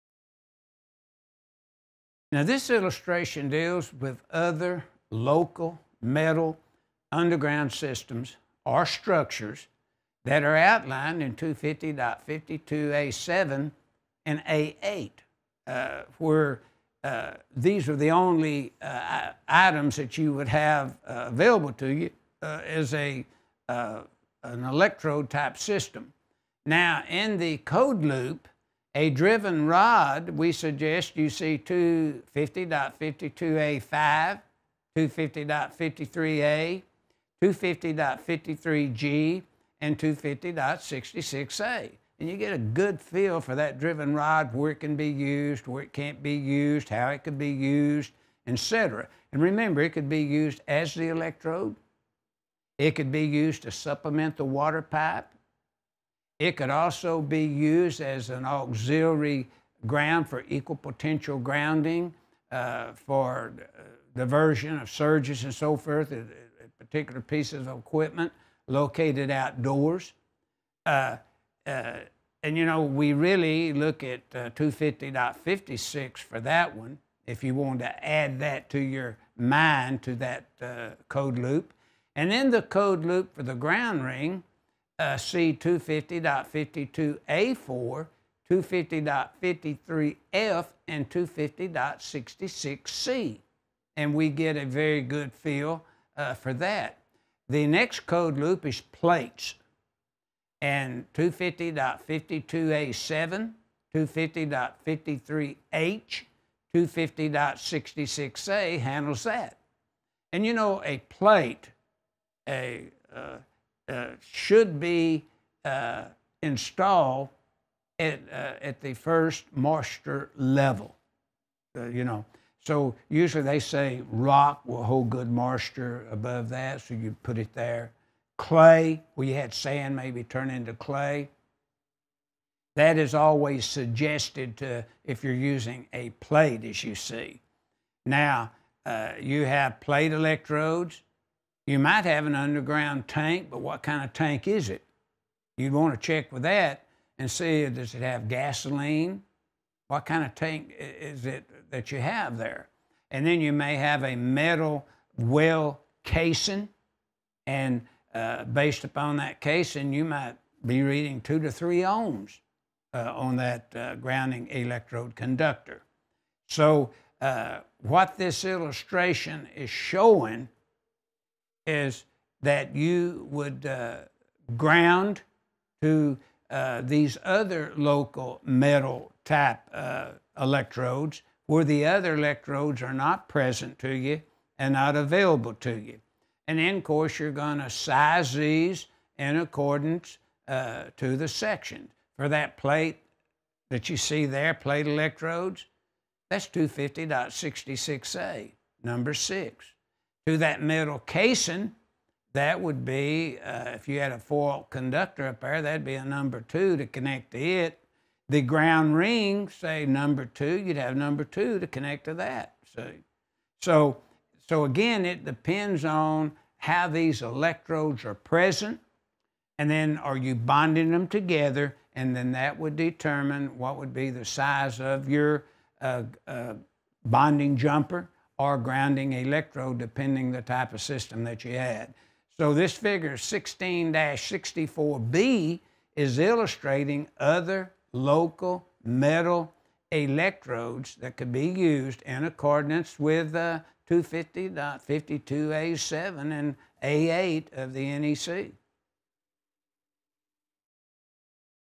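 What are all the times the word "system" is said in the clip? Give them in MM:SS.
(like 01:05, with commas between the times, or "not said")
00:07, 00:25, 03:50.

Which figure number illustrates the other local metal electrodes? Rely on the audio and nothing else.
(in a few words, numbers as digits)
16-64B.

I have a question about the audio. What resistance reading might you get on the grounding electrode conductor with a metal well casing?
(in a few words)
2 to 3 ohms.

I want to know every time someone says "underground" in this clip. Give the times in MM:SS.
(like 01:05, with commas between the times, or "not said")
00:07, 02:22.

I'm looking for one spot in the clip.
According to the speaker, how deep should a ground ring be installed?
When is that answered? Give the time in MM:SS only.
01:58.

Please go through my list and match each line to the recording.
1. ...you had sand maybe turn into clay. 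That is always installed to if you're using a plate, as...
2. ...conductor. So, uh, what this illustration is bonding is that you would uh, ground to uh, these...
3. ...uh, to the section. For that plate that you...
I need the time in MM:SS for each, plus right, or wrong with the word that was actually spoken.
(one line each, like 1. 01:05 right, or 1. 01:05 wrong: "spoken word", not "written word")
1. 02:09 wrong: "suggested", not "installed"
2. 02:45 wrong: "showing", not "bonding"
3. 03:10 right.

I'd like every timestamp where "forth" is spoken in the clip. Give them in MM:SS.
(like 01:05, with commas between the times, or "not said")
01:05.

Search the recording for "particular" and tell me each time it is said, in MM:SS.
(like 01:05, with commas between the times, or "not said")
01:06.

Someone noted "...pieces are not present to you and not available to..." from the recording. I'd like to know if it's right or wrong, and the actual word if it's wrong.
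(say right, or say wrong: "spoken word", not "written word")
wrong: "electrodes", not "pieces".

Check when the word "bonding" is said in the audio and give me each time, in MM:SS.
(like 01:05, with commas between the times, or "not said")
03:40, 03:47.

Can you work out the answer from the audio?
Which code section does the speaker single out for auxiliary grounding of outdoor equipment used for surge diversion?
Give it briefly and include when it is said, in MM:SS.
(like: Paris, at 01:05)
250.56, at 01:14.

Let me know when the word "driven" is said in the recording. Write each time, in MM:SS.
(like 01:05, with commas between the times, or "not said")
00:29, 00:43.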